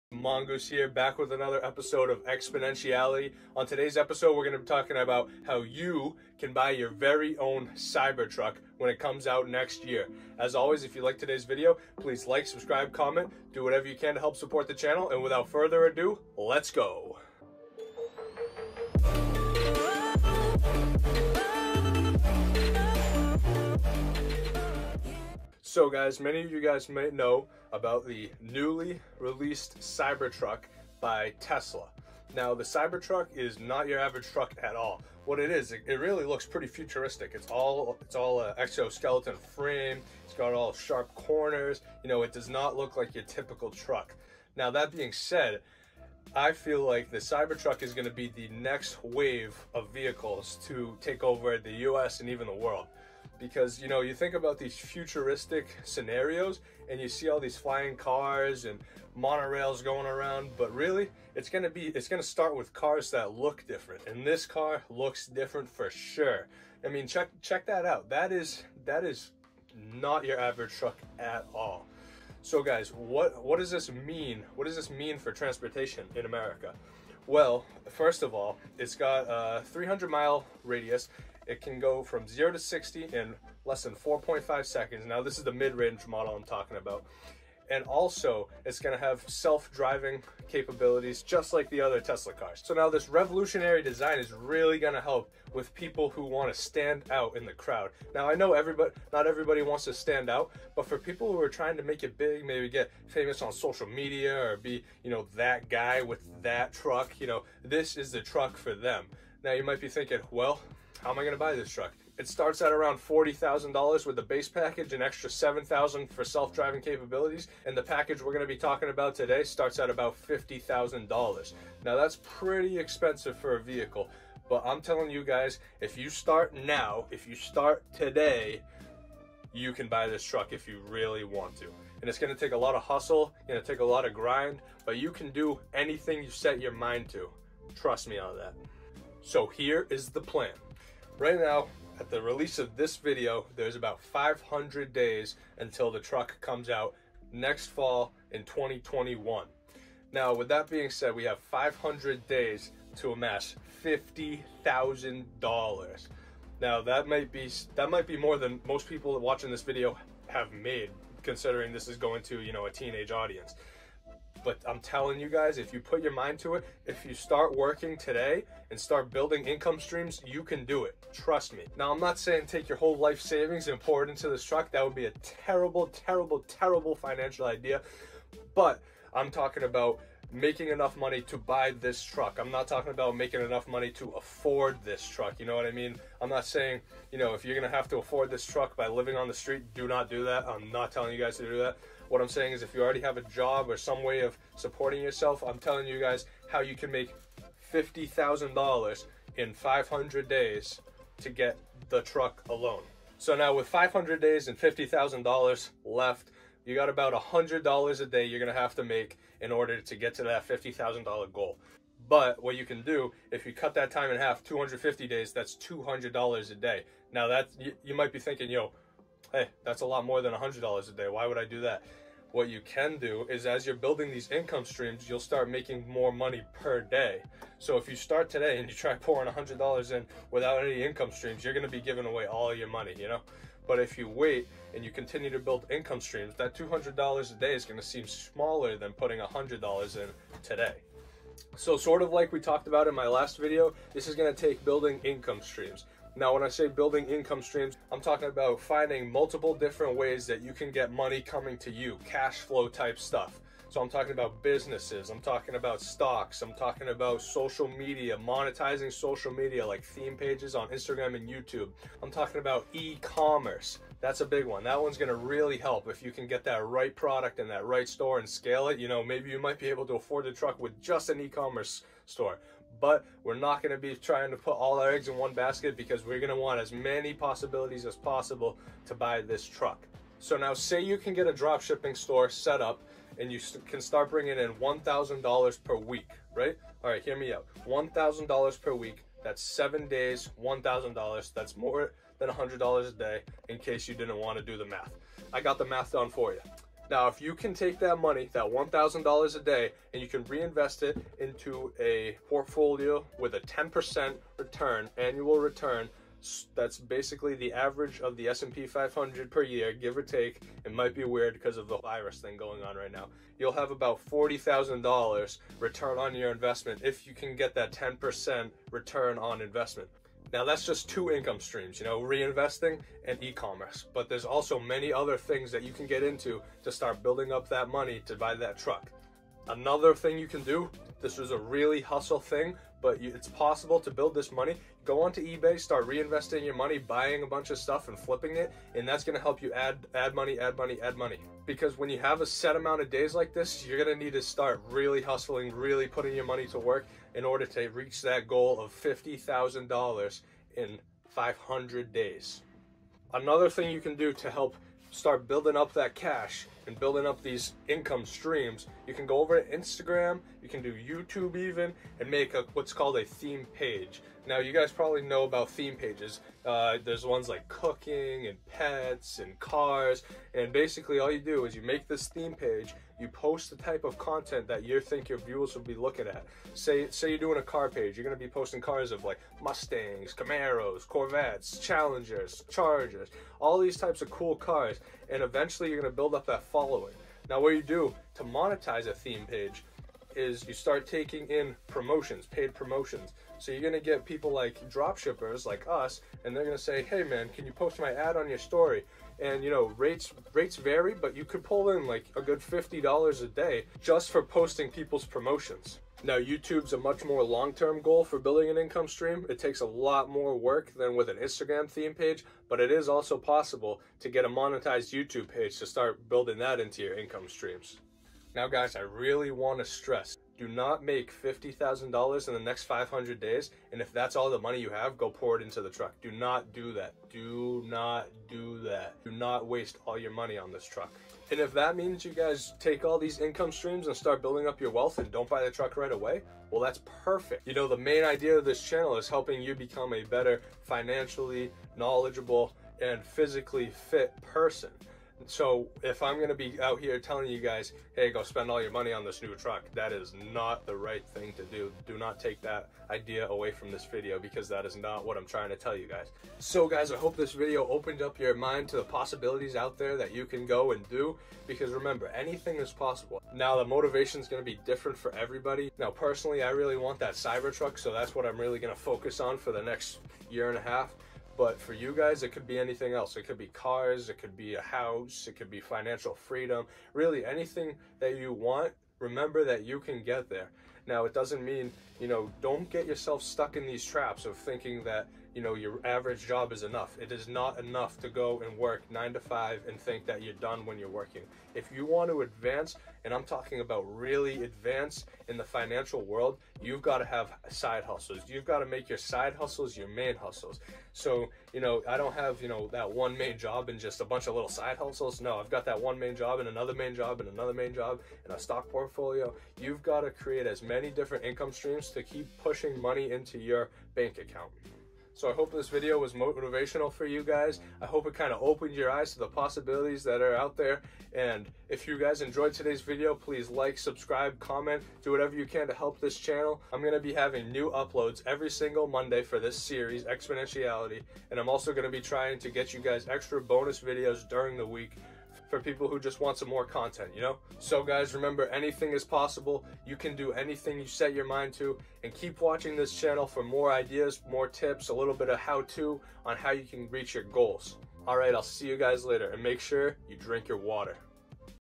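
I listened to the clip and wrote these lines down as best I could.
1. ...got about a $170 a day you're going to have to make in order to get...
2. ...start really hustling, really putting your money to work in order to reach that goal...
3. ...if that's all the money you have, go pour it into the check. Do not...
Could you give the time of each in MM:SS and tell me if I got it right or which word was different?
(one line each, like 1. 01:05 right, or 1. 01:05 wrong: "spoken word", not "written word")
1. 03:26 wrong: "100", not "170"
2. 05:44 right
3. 07:03 wrong: "truck", not "check".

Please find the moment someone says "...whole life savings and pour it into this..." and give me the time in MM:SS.
02:52.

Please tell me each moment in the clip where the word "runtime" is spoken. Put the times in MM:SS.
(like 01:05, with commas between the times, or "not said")
not said.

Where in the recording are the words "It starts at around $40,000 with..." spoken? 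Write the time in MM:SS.
01:52.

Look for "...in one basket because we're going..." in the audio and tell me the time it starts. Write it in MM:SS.
04:35.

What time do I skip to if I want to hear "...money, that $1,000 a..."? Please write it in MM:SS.
04:57.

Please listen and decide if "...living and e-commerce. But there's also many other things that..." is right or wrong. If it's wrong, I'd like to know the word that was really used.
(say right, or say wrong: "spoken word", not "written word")
wrong: "reinvesting", not "living".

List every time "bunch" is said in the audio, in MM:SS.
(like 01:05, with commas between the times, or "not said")
05:37, 08:24.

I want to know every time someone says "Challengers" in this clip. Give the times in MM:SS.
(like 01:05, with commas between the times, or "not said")
06:21.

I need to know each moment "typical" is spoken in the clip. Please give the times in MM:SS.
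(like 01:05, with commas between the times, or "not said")
00:43.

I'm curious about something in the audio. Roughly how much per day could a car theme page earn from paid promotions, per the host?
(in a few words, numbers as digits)
$50.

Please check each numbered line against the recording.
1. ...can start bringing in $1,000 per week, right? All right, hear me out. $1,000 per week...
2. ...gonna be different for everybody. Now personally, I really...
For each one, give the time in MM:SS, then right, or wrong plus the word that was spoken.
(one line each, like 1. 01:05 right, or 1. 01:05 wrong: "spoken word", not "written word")
1. 04:43 right
2. 07:44 right.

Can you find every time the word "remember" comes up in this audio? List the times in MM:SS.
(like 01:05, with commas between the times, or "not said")
07:41, 07:58, 08:58.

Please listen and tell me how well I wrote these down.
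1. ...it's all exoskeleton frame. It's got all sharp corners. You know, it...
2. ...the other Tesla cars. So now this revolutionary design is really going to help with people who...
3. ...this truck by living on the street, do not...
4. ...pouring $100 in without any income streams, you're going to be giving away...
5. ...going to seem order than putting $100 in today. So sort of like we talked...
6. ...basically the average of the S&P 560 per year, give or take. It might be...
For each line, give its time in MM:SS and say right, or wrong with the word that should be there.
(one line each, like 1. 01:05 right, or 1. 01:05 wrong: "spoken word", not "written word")
1. 00:38 right
2. 01:31 right
3. 03:08 right
4. 03:48 right
5. 03:57 wrong: "smaller", not "order"
6. 05:06 wrong: "500", not "560".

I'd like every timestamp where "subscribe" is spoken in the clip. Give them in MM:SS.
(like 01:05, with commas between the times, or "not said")
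00:12, 08:43.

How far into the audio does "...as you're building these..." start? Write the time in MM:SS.
03:43.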